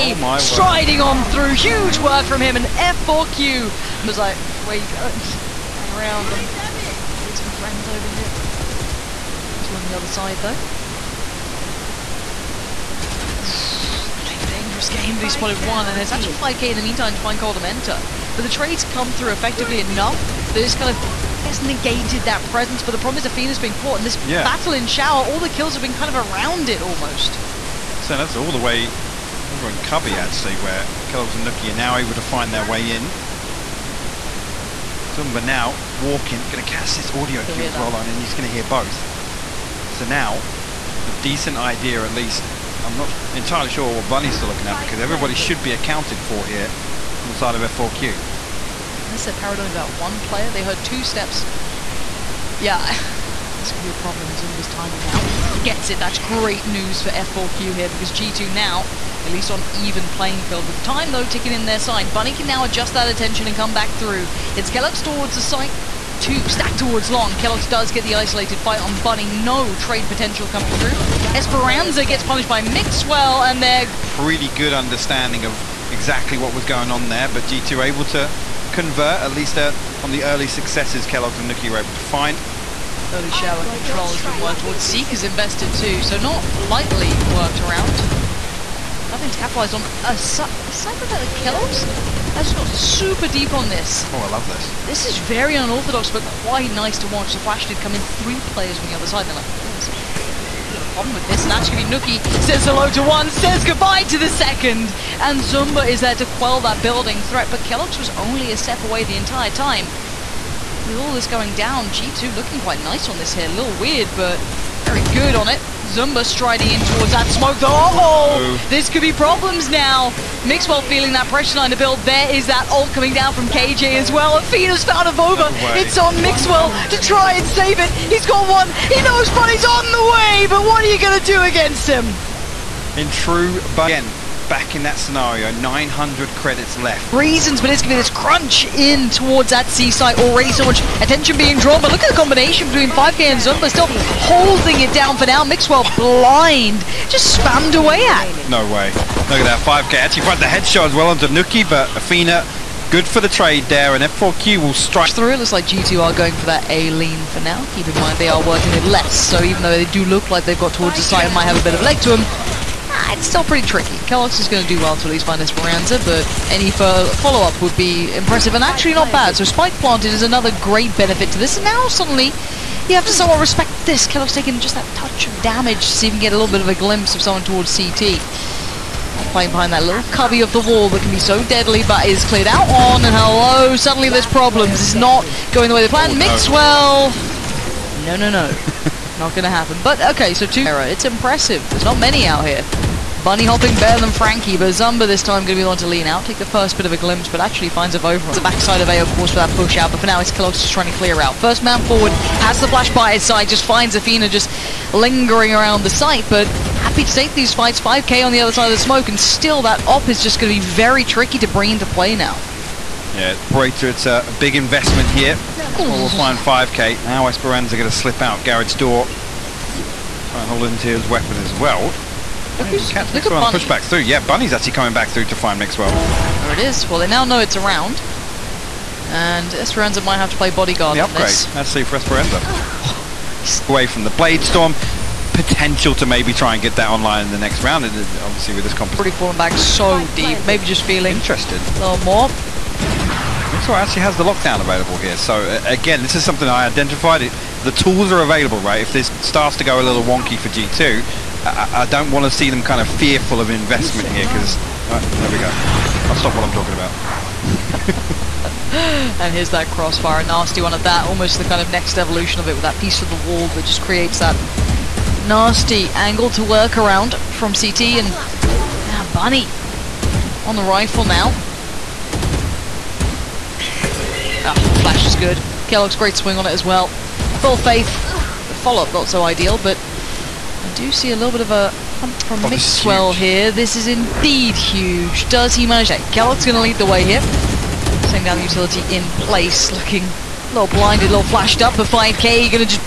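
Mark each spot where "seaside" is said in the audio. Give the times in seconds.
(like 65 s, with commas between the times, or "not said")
139 s.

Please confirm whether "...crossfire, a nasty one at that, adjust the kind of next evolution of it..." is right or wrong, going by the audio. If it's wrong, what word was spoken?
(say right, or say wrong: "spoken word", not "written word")
wrong: "almost", not "adjust".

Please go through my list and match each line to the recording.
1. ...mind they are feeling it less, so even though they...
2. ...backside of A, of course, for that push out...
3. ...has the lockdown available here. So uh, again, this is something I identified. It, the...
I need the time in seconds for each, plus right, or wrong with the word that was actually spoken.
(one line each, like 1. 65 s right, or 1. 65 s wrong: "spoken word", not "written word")
1. 157 s wrong: "working", not "feeling"
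2. 198 s right
3. 244 s right.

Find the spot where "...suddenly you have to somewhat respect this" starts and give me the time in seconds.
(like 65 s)
171 s.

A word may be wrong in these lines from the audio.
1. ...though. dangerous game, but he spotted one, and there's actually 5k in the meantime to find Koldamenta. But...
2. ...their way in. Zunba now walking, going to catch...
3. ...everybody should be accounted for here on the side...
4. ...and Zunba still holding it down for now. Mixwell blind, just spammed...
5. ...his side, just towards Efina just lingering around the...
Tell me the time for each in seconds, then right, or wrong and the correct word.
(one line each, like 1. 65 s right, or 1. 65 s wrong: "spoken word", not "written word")
1. 10 s right
2. 32 s right
3. 44 s right
4. 143 s right
5. 203 s wrong: "finds", not "towards".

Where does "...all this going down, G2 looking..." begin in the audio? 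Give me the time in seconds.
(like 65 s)
110 s.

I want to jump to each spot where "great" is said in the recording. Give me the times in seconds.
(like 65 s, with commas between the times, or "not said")
56 s, 170 s, 275 s.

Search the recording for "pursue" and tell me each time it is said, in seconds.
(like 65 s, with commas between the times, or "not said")
not said.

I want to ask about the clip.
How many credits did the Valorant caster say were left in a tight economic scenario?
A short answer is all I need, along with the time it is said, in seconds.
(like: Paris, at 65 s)
900, at 135 s.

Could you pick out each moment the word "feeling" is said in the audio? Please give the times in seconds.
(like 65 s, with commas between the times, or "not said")
120 s, 240 s.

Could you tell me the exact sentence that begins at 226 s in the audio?
Well, they now know it's around.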